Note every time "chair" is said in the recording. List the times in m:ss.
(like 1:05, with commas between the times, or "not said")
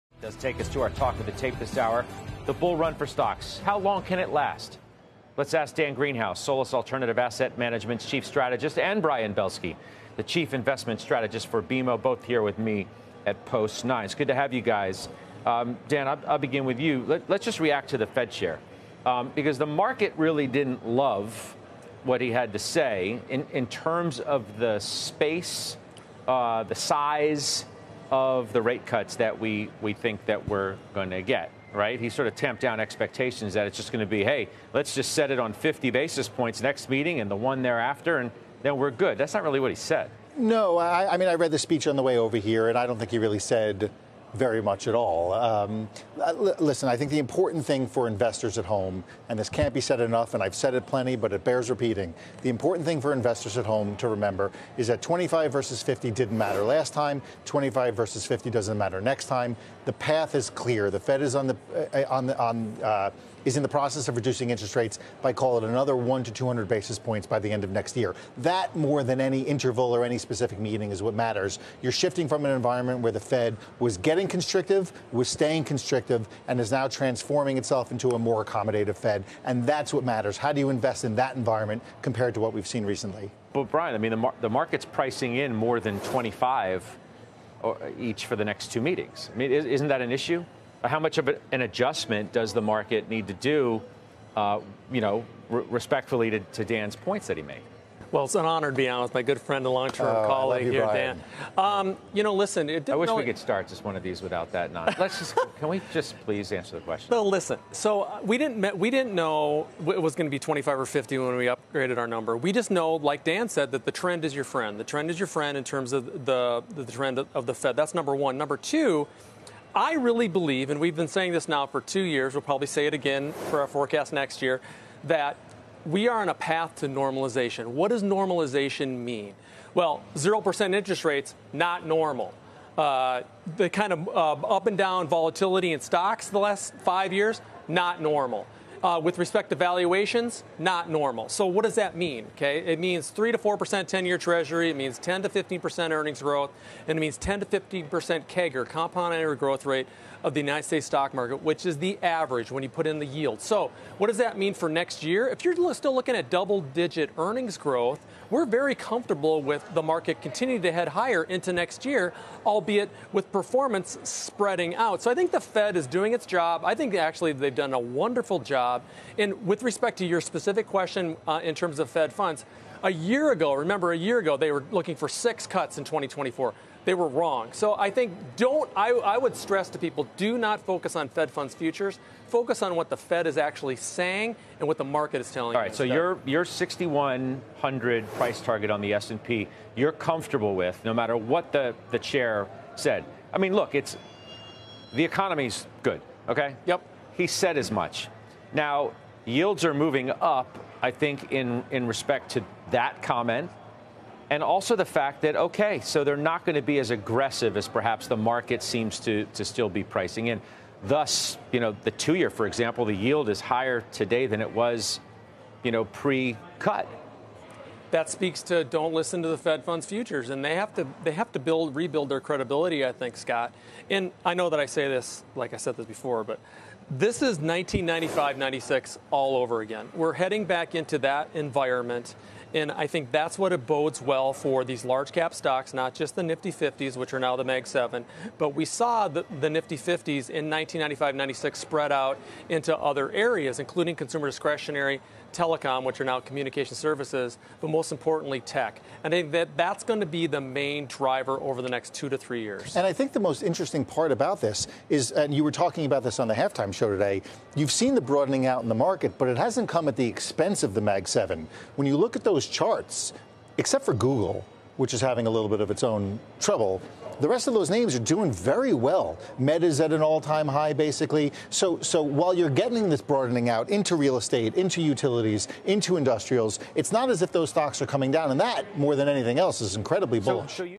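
0:18, 3:11.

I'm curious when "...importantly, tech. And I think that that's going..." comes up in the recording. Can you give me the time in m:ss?
4:07.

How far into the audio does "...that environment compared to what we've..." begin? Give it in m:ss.
1:21.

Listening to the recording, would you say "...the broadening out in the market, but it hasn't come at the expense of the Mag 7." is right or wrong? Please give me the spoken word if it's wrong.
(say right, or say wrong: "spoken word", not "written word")
right.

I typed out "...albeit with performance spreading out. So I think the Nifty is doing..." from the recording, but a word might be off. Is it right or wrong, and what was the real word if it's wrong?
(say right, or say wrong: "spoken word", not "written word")
wrong: "Fed", not "Nifty".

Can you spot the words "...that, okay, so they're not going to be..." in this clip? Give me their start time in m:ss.
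3:25.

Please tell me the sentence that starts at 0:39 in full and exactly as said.
That's not really what he said.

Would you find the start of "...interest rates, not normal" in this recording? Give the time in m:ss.
2:10.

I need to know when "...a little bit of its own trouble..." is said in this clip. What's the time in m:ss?
4:25.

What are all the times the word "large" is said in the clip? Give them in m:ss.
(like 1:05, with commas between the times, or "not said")
3:54.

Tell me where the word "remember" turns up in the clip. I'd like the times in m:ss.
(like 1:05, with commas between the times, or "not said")
0:54, 2:53.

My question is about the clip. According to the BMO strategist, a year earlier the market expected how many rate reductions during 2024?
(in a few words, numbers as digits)
6.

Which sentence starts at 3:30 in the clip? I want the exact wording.
Thus, you know, the two year, for example, the yield is higher today than it was, you know, pre cut.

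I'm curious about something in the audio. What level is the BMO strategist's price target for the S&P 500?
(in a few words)
6,100.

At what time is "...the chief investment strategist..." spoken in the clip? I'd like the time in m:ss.
0:10.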